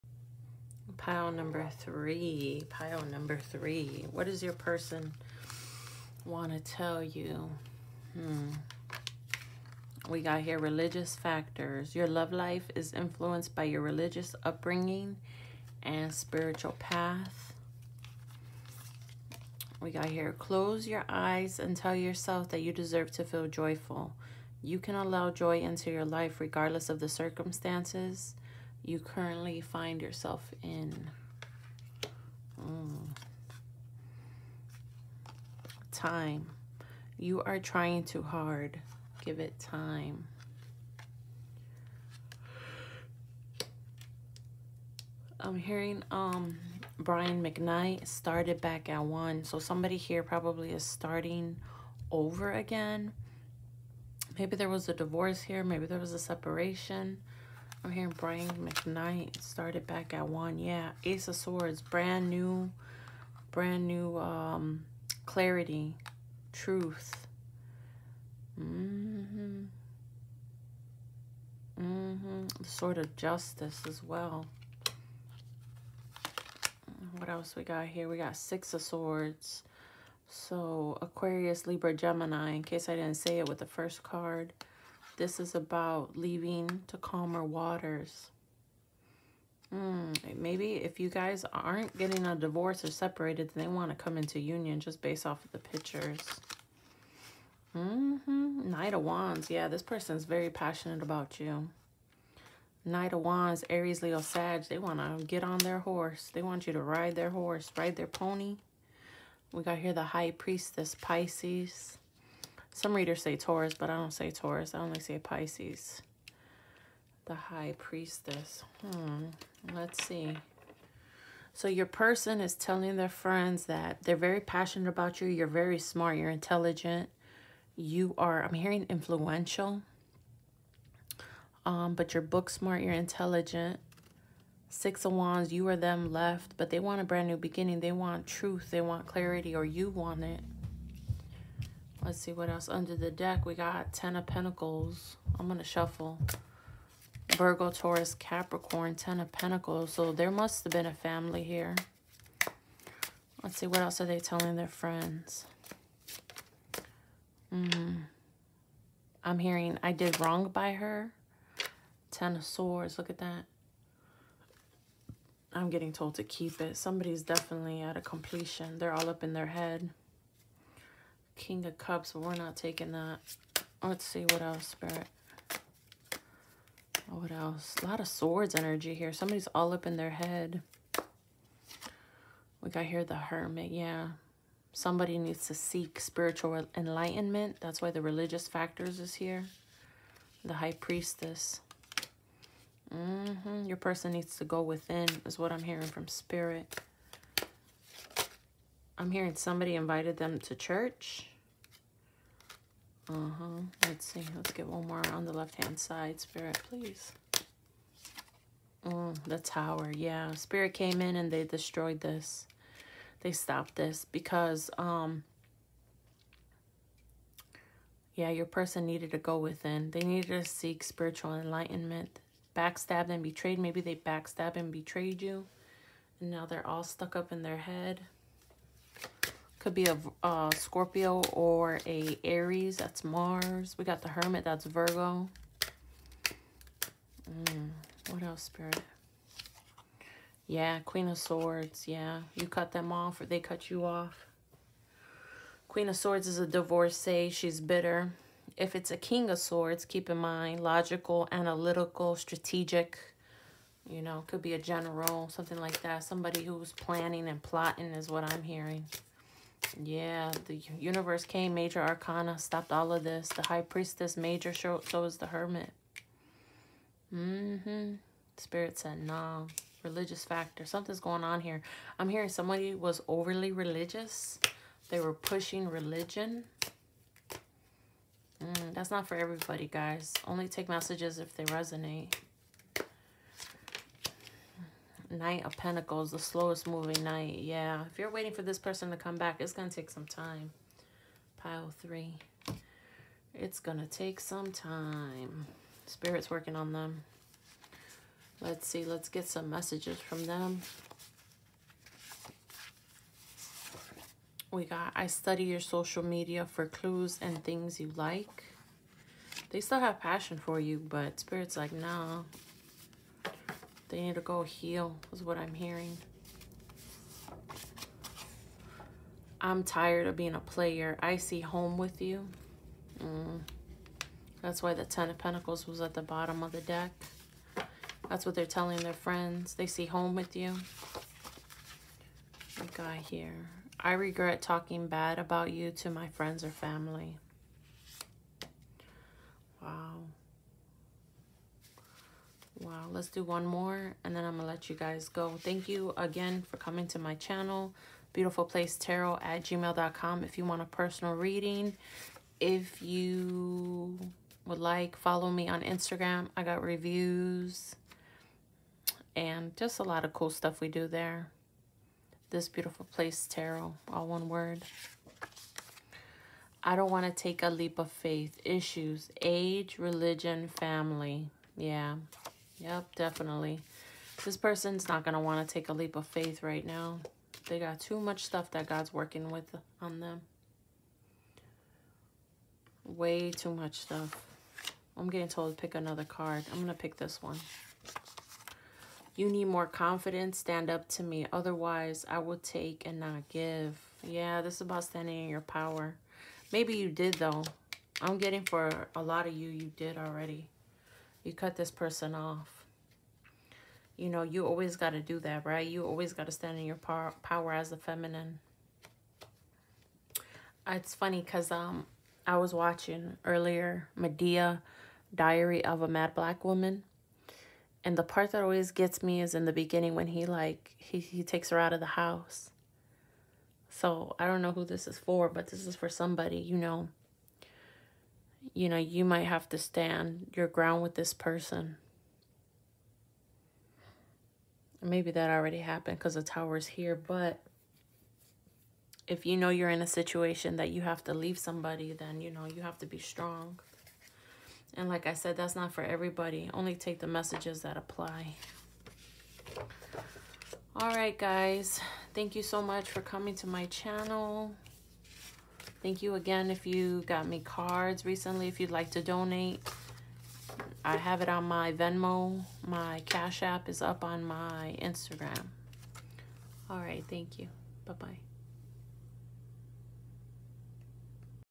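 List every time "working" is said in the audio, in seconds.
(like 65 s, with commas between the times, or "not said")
296 s, 378 s.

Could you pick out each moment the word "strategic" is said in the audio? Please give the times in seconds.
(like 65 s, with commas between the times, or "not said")
252 s.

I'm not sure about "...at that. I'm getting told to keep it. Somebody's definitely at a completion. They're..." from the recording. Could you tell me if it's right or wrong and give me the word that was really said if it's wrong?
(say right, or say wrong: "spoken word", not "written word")
right.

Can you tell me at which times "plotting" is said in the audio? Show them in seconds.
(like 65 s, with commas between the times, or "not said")
257 s.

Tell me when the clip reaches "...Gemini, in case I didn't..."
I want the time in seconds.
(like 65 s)
81 s.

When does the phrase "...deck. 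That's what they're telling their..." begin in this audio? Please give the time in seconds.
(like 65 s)
326 s.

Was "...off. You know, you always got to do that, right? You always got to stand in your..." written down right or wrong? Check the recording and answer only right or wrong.
right.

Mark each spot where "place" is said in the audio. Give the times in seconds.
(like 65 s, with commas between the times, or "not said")
348 s, 362 s.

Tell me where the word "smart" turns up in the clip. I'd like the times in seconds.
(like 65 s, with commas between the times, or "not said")
125 s, 132 s.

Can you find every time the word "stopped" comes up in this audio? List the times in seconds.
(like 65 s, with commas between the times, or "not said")
213 s, 262 s.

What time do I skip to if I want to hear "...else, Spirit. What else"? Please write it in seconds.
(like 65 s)
174 s.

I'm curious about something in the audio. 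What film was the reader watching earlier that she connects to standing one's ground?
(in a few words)
Diary of a Mad Black Woman.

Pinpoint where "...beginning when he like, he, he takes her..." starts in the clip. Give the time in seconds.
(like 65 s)
419 s.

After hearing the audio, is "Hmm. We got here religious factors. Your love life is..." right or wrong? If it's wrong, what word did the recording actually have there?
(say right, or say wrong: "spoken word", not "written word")
right.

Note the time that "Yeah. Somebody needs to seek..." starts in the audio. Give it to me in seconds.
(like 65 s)
183 s.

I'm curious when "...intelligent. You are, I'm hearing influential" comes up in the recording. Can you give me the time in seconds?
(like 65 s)
126 s.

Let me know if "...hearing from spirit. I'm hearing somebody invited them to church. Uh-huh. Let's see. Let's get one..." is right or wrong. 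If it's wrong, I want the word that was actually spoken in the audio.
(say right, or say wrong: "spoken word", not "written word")
right.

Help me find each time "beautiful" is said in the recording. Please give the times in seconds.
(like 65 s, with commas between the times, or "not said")
348 s, 362 s.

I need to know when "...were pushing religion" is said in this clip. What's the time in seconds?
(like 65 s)
274 s.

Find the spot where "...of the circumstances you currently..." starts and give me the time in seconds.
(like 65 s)
26 s.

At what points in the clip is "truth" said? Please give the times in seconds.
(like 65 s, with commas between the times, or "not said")
66 s, 138 s.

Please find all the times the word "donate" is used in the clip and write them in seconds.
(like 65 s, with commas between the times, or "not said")
459 s.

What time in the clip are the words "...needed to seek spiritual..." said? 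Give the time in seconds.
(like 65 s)
220 s.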